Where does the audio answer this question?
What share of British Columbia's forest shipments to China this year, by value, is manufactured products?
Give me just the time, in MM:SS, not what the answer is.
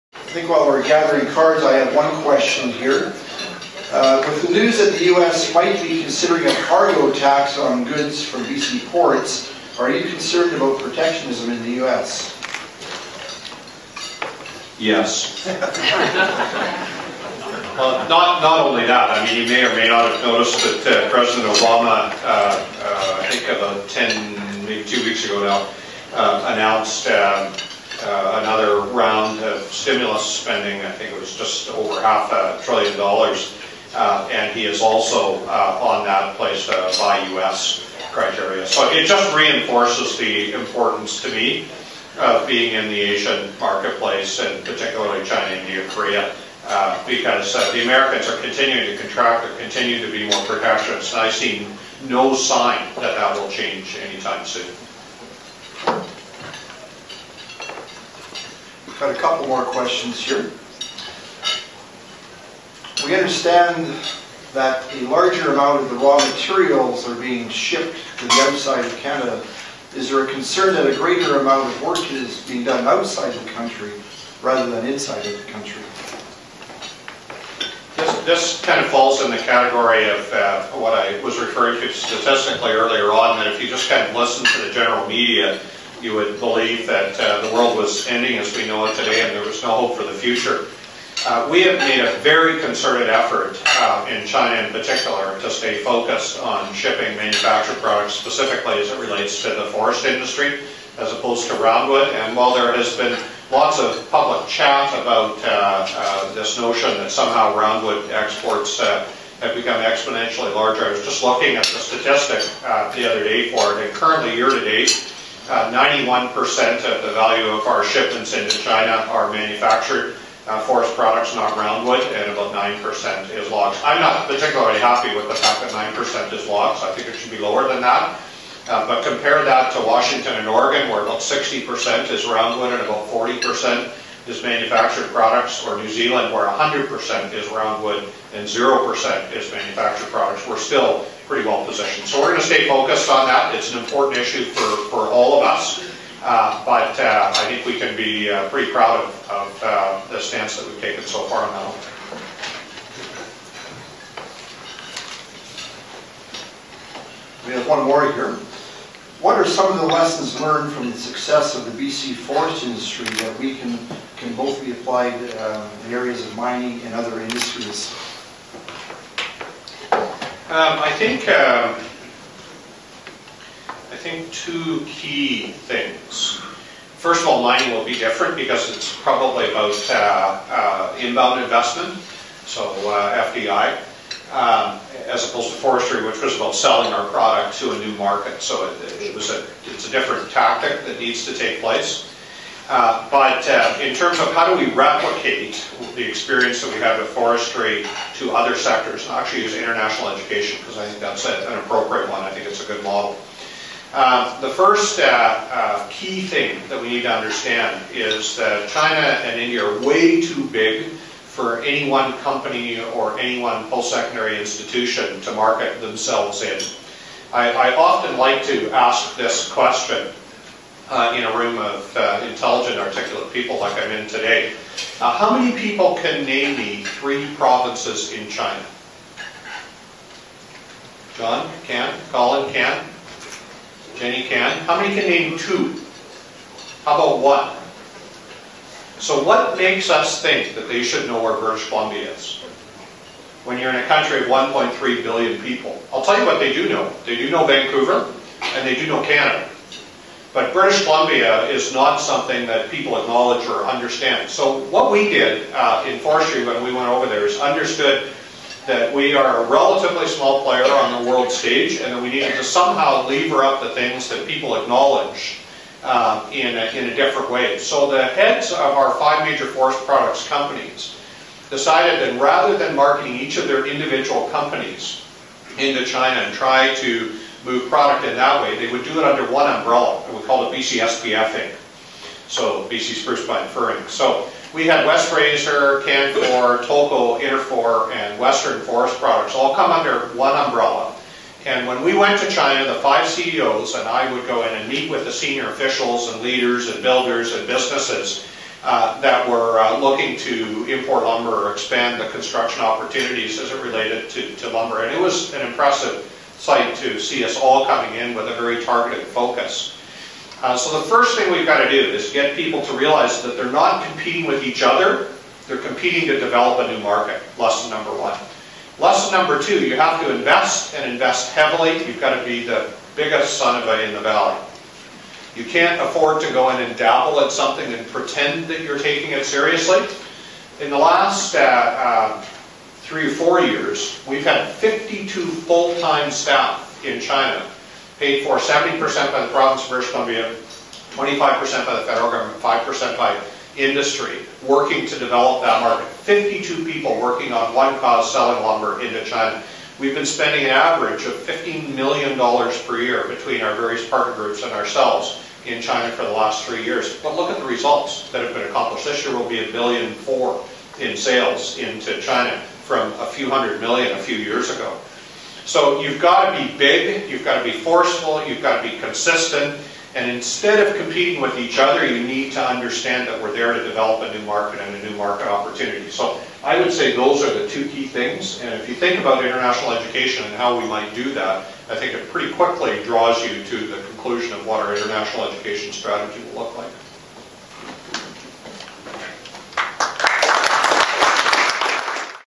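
01:55.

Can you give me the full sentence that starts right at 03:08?
So it, it was a it's a different tactic that needs to take place.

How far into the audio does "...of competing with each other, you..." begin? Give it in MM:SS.
06:10.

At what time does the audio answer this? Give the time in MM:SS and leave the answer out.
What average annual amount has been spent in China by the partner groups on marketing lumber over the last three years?
05:51.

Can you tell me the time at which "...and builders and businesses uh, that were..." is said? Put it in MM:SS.
04:56.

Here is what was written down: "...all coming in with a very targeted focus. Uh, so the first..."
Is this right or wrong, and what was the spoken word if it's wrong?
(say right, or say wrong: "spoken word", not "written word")
right.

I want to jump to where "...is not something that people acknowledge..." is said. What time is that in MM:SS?
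04:11.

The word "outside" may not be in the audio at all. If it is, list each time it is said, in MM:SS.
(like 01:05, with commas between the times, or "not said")
01:08, 01:12.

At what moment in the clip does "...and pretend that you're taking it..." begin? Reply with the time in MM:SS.
05:27.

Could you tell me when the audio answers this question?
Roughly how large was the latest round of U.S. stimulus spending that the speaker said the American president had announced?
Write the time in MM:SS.
00:31.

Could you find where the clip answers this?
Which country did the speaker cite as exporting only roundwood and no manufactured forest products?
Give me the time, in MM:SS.
02:15.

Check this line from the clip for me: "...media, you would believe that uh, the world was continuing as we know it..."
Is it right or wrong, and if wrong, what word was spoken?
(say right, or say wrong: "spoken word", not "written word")
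wrong: "ending", not "continuing".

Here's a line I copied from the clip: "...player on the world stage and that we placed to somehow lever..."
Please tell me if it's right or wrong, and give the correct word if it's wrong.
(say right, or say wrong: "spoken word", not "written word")
wrong: "needed", not "placed".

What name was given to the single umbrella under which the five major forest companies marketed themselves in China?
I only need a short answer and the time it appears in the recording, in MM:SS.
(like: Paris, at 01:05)
BC Inc., at 04:40.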